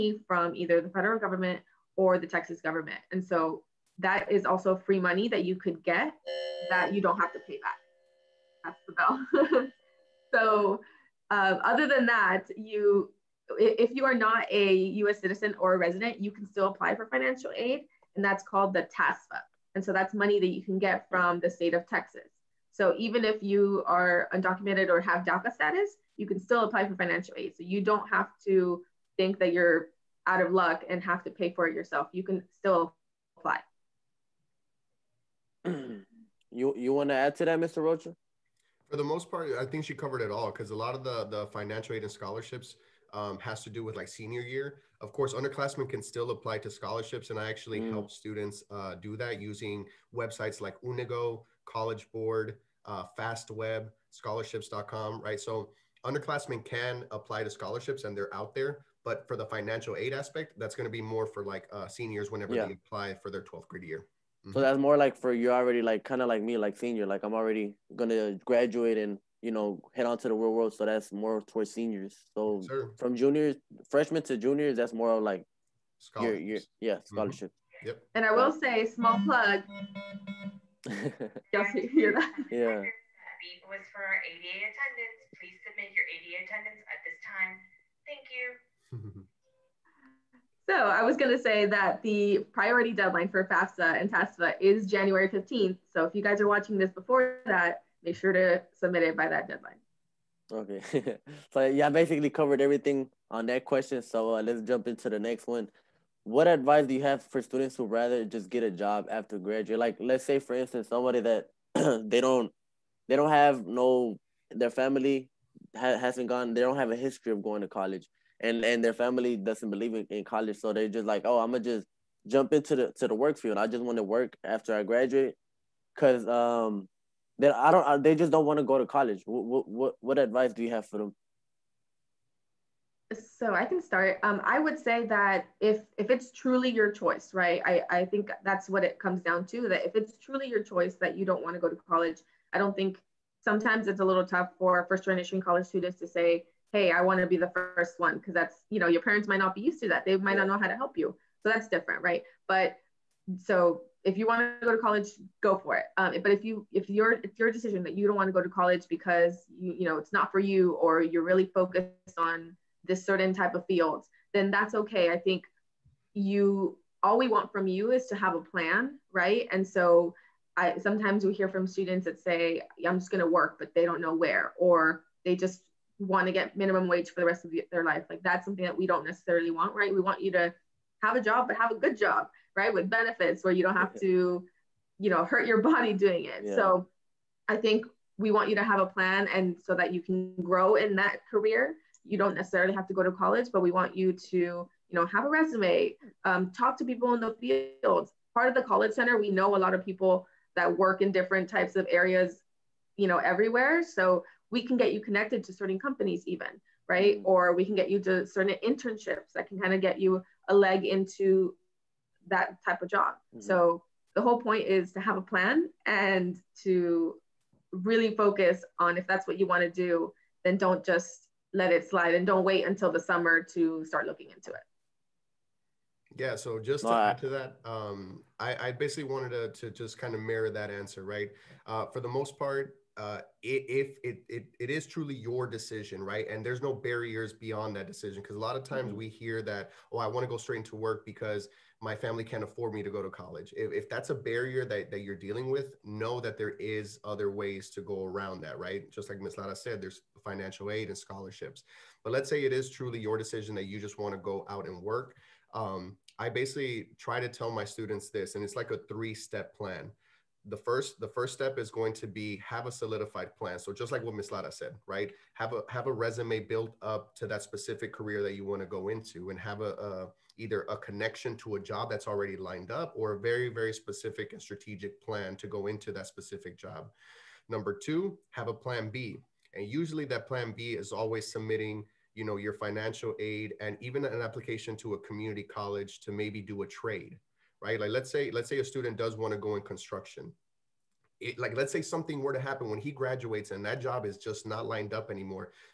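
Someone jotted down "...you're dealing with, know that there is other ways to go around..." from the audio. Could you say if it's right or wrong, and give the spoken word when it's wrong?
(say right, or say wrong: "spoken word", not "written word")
right.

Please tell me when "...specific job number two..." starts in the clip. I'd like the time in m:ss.
4:36.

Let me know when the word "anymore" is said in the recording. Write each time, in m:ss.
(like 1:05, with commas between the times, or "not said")
4:55.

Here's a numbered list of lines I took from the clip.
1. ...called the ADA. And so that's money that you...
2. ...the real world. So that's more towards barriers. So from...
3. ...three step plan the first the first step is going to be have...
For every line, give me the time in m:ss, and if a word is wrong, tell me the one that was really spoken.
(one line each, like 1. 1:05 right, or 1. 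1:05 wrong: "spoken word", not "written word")
1. 0:18 wrong: "TASFA", not "ADA"
2. 1:10 wrong: "seniors", not "barriers"
3. 4:18 right.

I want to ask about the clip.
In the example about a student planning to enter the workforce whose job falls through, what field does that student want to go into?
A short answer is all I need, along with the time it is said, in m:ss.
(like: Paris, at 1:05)
Construction, at 4:49.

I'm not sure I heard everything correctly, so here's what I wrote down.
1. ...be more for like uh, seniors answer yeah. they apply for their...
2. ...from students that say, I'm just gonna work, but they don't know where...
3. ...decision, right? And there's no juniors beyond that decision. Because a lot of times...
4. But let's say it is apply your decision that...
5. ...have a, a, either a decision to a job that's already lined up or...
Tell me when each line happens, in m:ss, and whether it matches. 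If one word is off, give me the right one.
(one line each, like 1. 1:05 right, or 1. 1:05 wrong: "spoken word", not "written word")
1. 1:00 wrong: "whenever", not "answer"
2. 2:51 right
3. 3:55 wrong: "barriers", not "juniors"
4. 4:12 wrong: "truly", not "apply"
5. 4:29 wrong: "connection", not "decision".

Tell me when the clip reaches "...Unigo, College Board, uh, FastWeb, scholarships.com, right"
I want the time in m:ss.
0:50.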